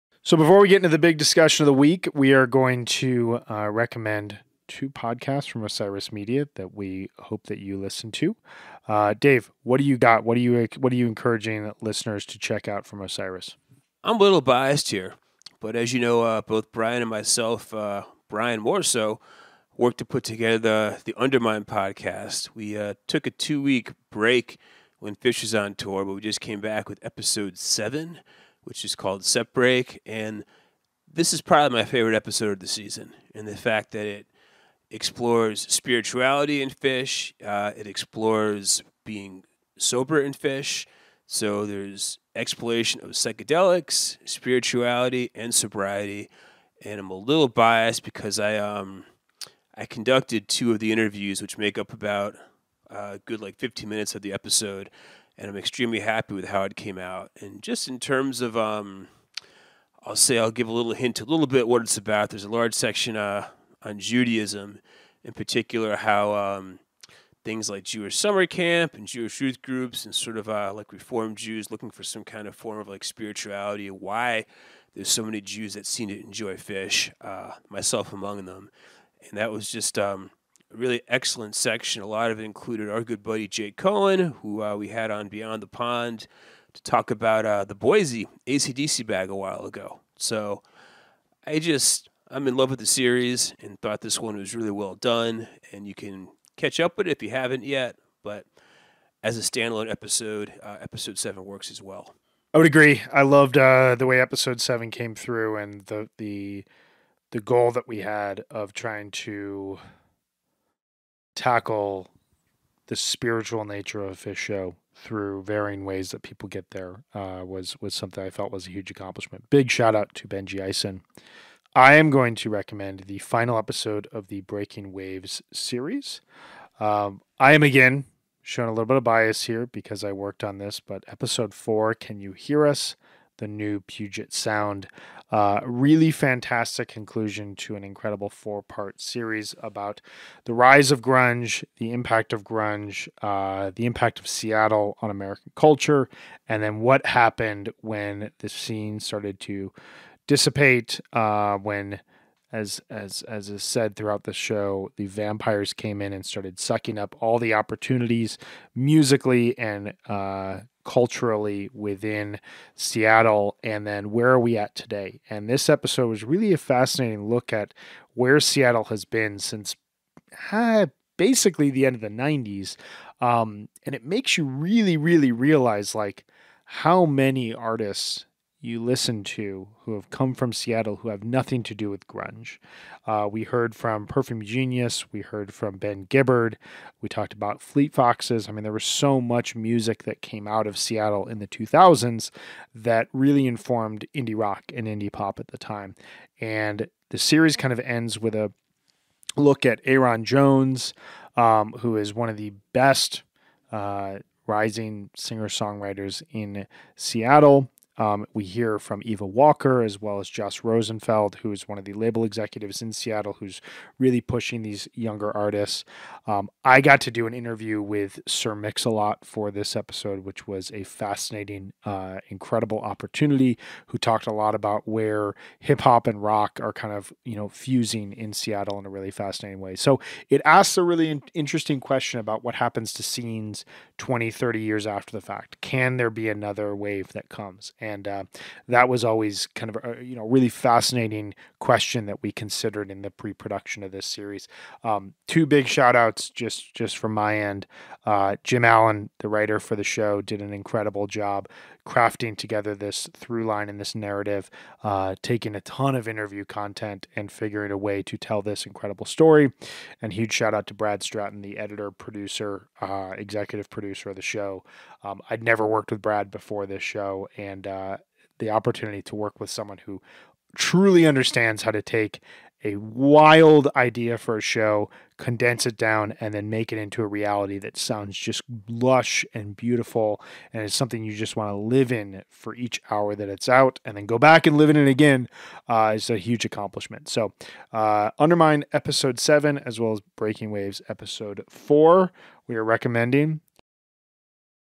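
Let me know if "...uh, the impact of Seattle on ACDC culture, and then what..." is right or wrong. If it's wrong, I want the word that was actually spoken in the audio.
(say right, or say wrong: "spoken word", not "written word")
wrong: "American", not "ACDC".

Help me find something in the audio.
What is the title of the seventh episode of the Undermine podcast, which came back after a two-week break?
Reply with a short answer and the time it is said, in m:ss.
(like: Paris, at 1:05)
Setbreak, at 0:29.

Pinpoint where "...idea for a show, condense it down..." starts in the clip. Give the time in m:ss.
4:33.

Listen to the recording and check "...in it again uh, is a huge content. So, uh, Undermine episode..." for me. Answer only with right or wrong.
wrong.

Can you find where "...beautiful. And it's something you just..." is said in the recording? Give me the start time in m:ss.
4:39.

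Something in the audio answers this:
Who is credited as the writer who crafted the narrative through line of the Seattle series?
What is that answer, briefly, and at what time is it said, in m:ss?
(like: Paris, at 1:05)
Jim Allen, at 4:08.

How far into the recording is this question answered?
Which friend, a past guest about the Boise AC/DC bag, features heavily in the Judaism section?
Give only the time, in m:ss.
1:23.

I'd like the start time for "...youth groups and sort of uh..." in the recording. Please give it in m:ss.
1:09.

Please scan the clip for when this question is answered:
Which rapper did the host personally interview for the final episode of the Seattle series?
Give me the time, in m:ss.
3:38.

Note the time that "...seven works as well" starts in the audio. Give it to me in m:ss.
1:41.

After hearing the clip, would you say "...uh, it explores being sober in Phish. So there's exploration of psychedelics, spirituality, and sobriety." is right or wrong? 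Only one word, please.
right.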